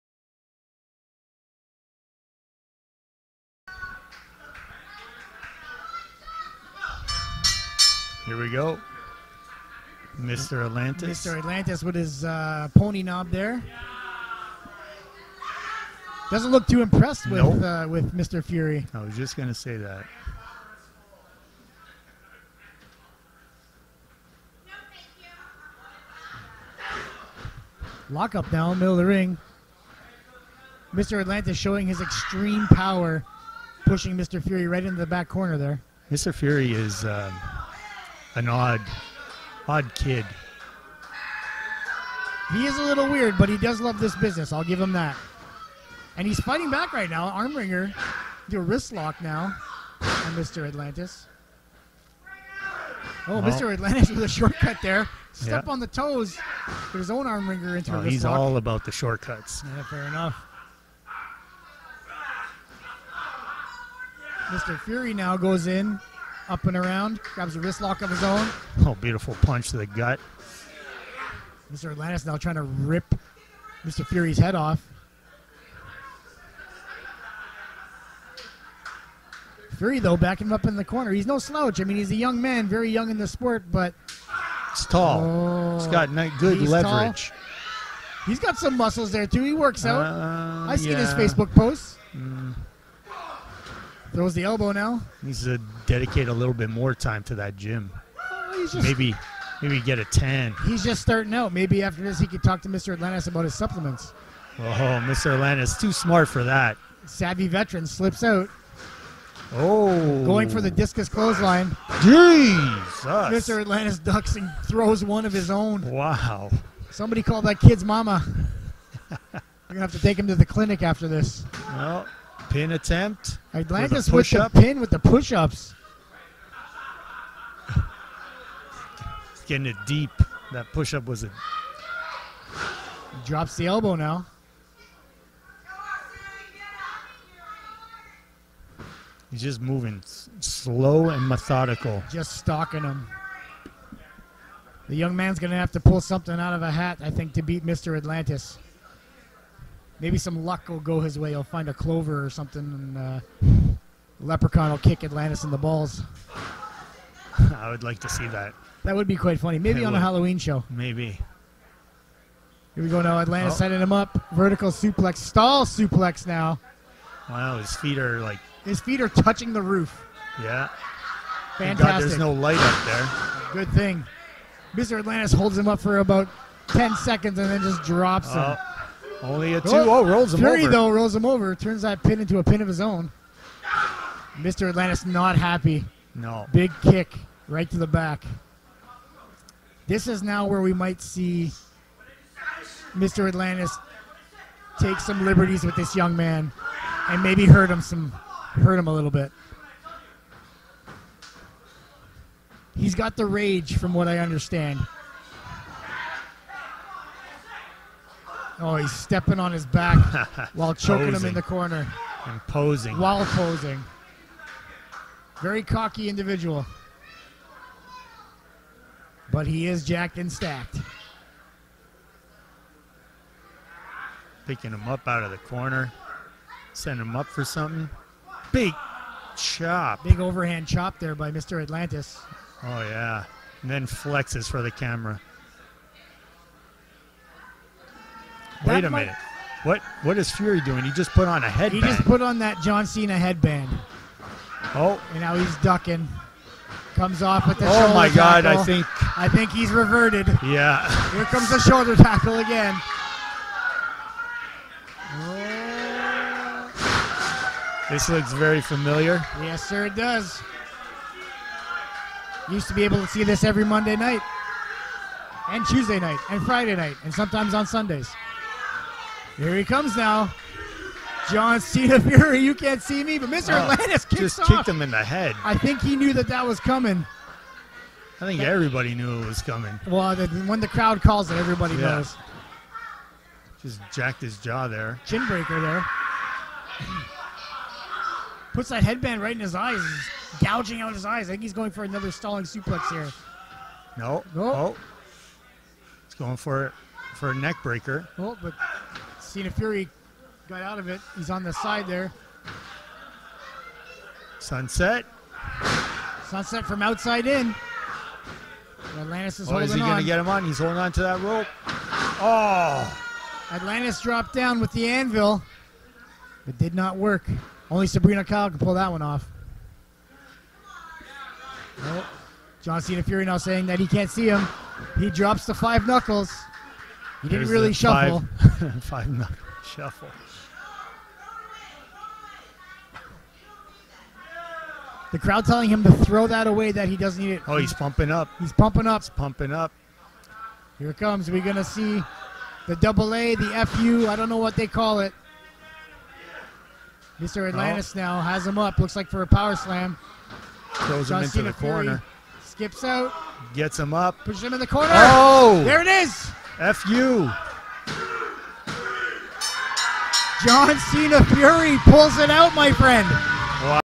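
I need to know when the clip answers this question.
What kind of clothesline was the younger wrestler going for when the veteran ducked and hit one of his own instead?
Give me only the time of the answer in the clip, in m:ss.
1:50.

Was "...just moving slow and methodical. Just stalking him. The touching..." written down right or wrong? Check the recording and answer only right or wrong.
wrong.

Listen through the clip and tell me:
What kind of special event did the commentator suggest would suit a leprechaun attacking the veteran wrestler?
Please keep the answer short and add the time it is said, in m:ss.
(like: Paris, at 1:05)
Halloween show, at 2:40.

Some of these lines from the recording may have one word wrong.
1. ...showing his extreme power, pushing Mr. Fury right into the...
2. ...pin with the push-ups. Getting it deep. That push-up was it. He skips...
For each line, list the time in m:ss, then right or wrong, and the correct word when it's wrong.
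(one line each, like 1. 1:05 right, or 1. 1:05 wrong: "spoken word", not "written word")
1. 0:31 right
2. 2:04 wrong: "drops", not "skips".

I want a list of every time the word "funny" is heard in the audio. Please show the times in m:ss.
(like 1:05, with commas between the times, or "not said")
2:39.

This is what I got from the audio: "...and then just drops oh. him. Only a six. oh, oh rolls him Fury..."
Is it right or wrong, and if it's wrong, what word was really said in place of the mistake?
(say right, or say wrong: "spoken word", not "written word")
wrong: "two", not "six".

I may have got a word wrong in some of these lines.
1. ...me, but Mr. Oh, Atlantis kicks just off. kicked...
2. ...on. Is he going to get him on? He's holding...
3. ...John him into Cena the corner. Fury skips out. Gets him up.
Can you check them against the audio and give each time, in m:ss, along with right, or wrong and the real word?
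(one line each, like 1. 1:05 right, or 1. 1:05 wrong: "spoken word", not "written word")
1. 4:33 right
2. 5:09 right
3. 5:51 right.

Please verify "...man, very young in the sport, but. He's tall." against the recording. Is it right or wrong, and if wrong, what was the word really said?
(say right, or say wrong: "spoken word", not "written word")
right.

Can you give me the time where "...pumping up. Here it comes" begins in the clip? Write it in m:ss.
5:39.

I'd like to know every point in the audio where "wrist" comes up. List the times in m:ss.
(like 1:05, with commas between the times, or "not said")
0:48, 0:58, 1:07.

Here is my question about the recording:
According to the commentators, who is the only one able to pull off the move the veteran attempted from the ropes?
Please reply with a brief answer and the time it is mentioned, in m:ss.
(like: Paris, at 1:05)
Sabrina Kyle, at 5:17.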